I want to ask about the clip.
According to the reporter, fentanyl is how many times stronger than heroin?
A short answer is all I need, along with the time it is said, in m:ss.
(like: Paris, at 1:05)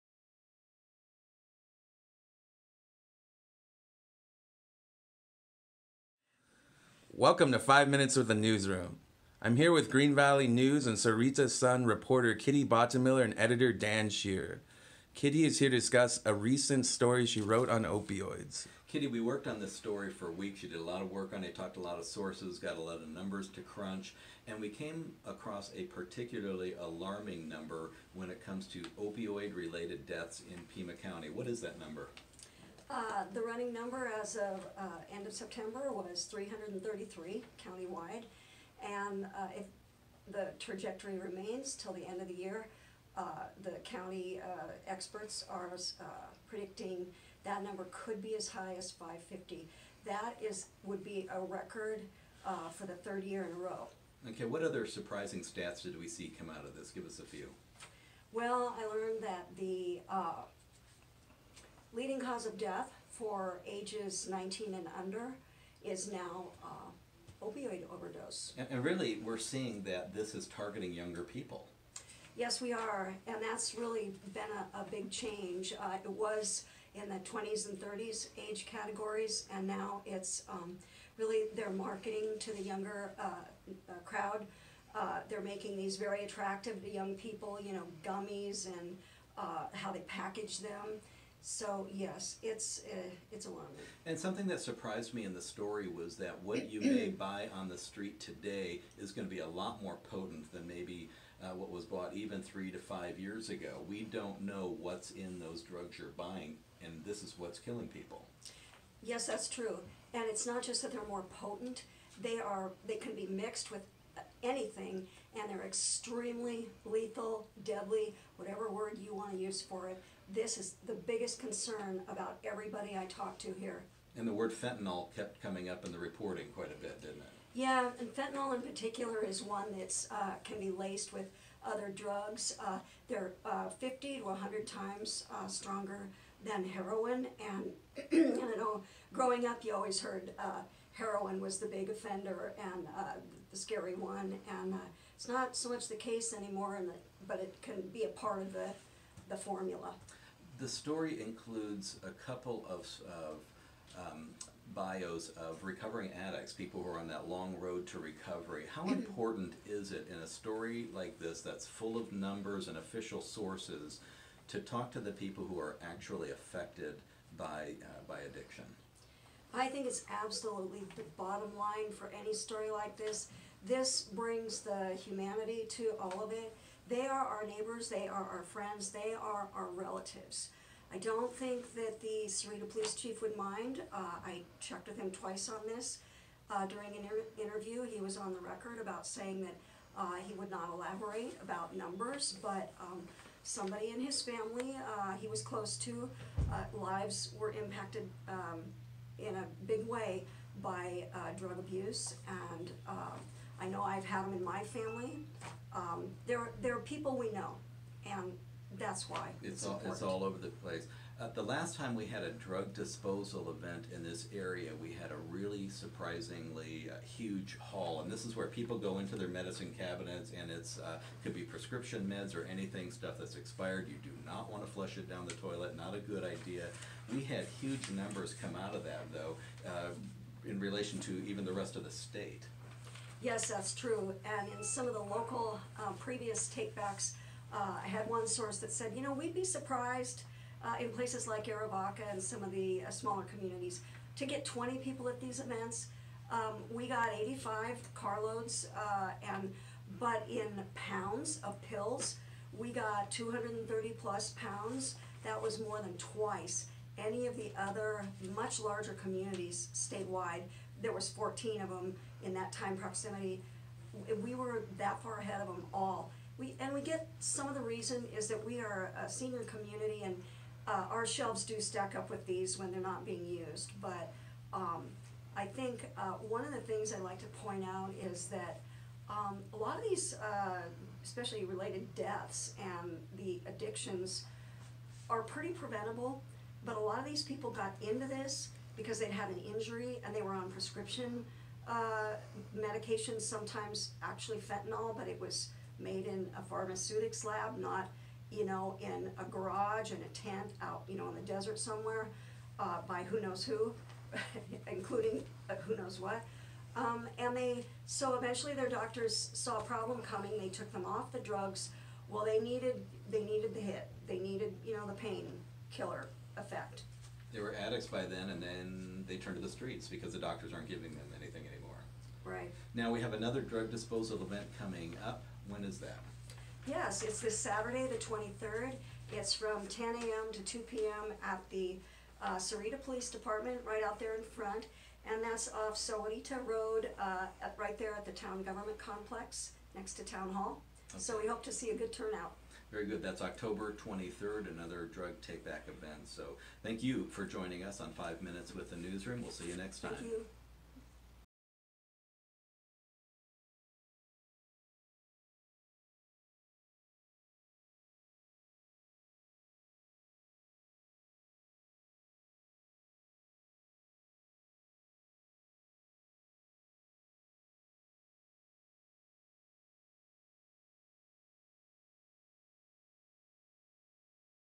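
50 to 100, at 2:13.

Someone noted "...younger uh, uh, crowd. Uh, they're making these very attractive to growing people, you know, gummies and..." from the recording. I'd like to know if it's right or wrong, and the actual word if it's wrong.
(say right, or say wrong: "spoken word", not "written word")
wrong: "young", not "growing".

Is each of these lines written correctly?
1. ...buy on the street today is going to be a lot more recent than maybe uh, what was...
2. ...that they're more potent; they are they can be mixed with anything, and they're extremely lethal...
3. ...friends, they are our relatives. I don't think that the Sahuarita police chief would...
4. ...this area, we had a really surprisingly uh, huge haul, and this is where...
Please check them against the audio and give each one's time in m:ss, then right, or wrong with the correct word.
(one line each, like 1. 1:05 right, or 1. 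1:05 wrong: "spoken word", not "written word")
1. 1:37 wrong: "potent", not "recent"
2. 1:50 right
3. 2:58 right
4. 3:34 right.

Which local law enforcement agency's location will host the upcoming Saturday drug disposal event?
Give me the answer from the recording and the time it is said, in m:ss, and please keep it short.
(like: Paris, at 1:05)
Sahuarita Police Department, at 5:32.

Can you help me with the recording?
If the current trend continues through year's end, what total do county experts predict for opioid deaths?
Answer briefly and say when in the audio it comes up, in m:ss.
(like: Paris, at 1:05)
550, at 0:48.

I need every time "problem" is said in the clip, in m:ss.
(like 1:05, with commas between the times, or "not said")
5:09.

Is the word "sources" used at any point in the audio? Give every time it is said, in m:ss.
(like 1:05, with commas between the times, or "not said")
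0:22, 2:43, 3:58.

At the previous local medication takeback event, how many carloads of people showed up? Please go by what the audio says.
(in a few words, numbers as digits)
85.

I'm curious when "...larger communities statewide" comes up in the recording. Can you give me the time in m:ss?
4:18.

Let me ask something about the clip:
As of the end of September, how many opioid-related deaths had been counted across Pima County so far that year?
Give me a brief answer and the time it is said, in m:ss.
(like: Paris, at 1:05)
333, at 0:36.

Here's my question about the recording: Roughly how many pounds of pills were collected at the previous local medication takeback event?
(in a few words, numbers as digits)
230 plus pounds.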